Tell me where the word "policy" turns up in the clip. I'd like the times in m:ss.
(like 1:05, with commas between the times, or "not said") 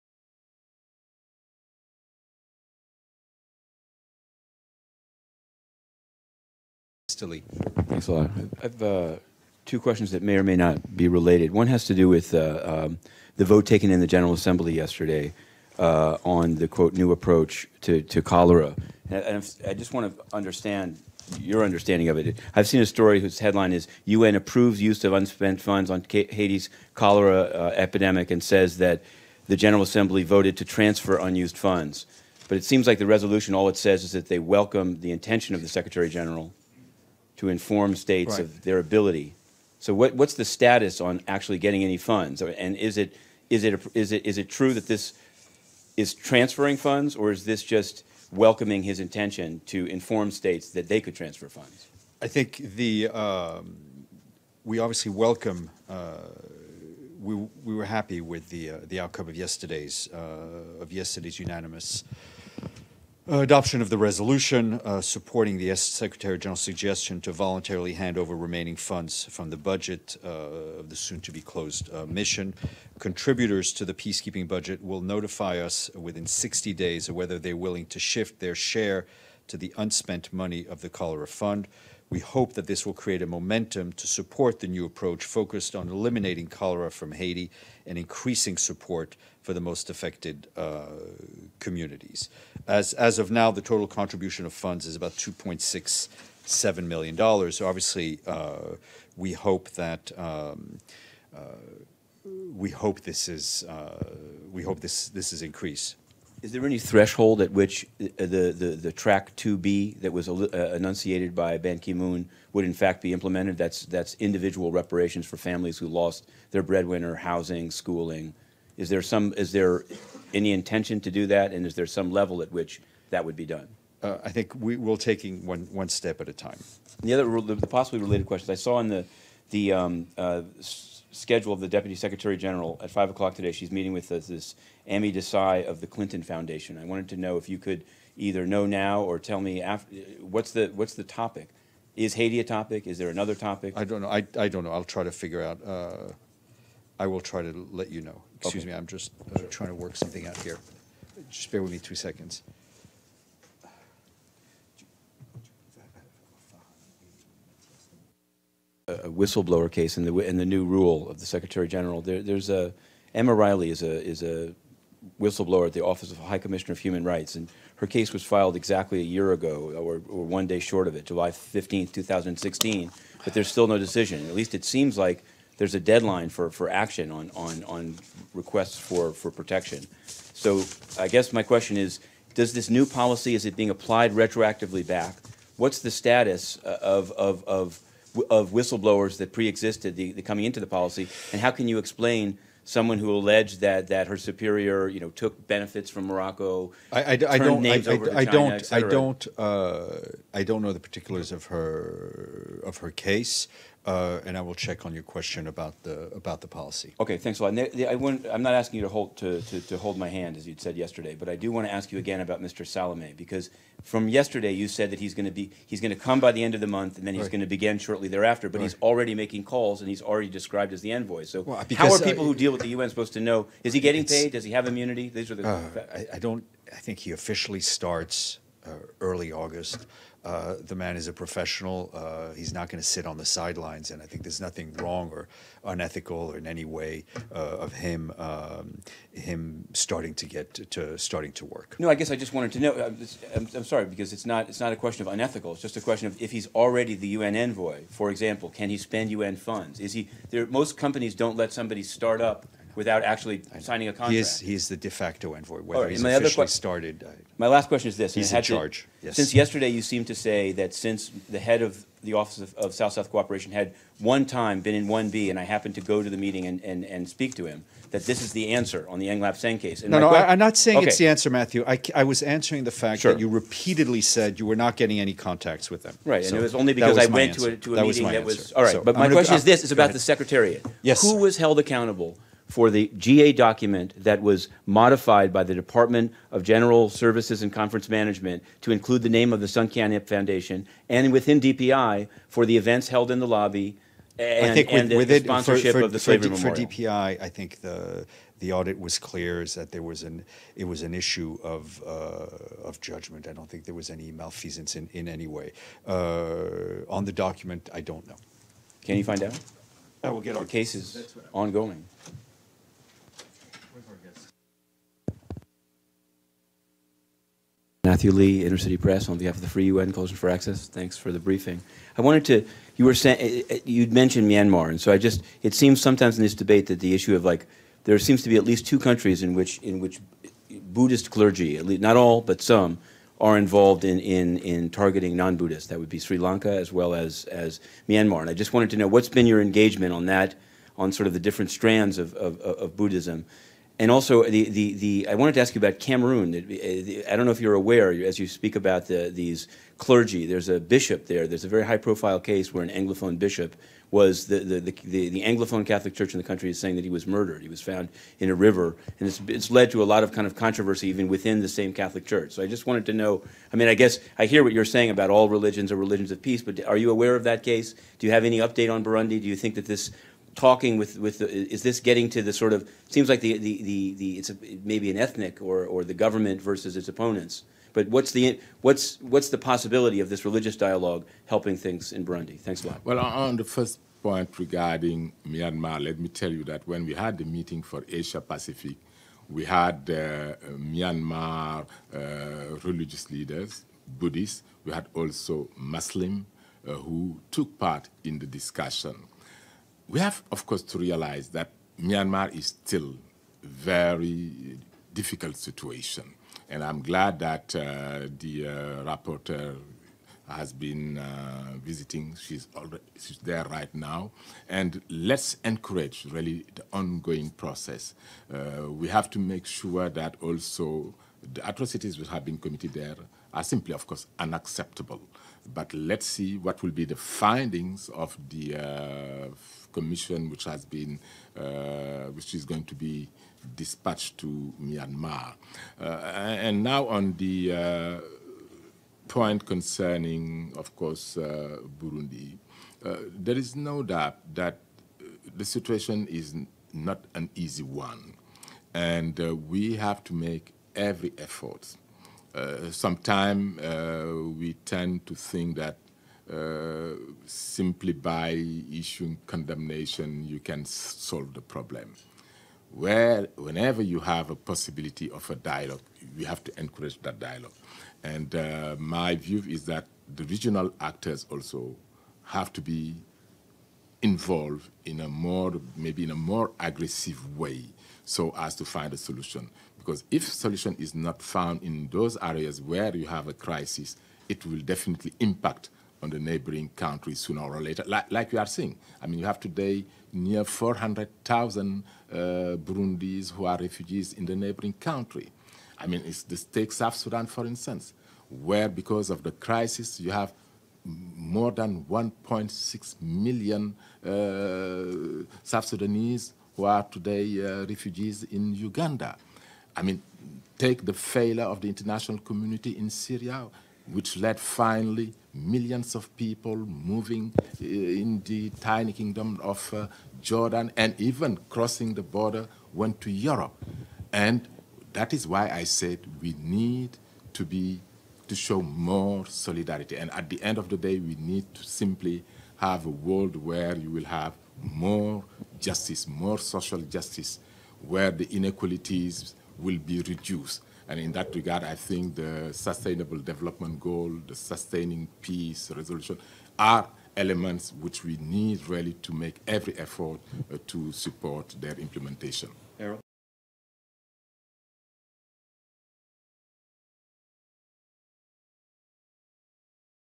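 3:02, 3:10, 3:26.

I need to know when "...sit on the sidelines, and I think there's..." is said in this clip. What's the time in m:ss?
3:52.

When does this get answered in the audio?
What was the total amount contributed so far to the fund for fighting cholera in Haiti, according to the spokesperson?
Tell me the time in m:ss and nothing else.
1:35.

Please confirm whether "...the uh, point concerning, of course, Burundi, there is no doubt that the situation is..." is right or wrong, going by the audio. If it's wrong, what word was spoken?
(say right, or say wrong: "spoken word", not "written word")
right.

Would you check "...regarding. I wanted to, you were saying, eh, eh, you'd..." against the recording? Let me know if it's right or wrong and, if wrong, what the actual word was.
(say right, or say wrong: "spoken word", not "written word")
wrong: "briefing", not "regarding".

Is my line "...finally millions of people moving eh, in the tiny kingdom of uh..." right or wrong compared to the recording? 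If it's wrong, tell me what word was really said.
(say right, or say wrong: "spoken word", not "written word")
right.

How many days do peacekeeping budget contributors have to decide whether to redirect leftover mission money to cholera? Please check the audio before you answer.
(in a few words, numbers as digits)
60 days.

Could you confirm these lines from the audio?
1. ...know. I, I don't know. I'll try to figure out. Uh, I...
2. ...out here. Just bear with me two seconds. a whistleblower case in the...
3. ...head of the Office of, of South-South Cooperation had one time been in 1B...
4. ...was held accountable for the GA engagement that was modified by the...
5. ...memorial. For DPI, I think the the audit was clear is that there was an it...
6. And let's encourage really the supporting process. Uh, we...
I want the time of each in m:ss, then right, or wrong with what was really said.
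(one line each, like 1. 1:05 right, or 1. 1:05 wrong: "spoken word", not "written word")
1. 2:24 right
2. 2:30 right
3. 4:21 right
4. 4:41 wrong: "document", not "engagement"
5. 4:56 right
6. 6:54 wrong: "ongoing", not "supporting".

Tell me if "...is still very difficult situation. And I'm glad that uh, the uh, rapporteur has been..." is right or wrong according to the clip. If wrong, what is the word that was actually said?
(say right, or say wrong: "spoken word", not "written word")
right.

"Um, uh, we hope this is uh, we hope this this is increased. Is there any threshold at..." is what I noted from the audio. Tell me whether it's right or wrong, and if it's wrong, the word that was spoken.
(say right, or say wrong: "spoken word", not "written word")
right.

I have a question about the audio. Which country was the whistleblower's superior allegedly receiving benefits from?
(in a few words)
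Morocco.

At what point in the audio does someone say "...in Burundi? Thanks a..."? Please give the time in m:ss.
6:21.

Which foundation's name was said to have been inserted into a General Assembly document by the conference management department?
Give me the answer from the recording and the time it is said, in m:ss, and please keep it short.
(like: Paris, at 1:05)
Suncan Foundation, at 4:49.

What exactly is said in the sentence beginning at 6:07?
Do you have any update on Burundi?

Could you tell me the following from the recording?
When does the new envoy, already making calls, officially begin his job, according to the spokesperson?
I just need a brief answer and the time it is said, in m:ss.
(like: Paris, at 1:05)
early August, at 3:48.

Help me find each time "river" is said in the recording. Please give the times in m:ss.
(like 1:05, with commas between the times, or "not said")
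5:58.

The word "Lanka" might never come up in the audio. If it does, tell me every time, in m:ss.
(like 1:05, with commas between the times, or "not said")
5:36.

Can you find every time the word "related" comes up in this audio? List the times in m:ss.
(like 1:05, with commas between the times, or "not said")
0:11, 2:07.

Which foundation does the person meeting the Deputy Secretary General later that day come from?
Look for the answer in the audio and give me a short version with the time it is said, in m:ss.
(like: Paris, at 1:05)
Clinton Foundation, at 2:15.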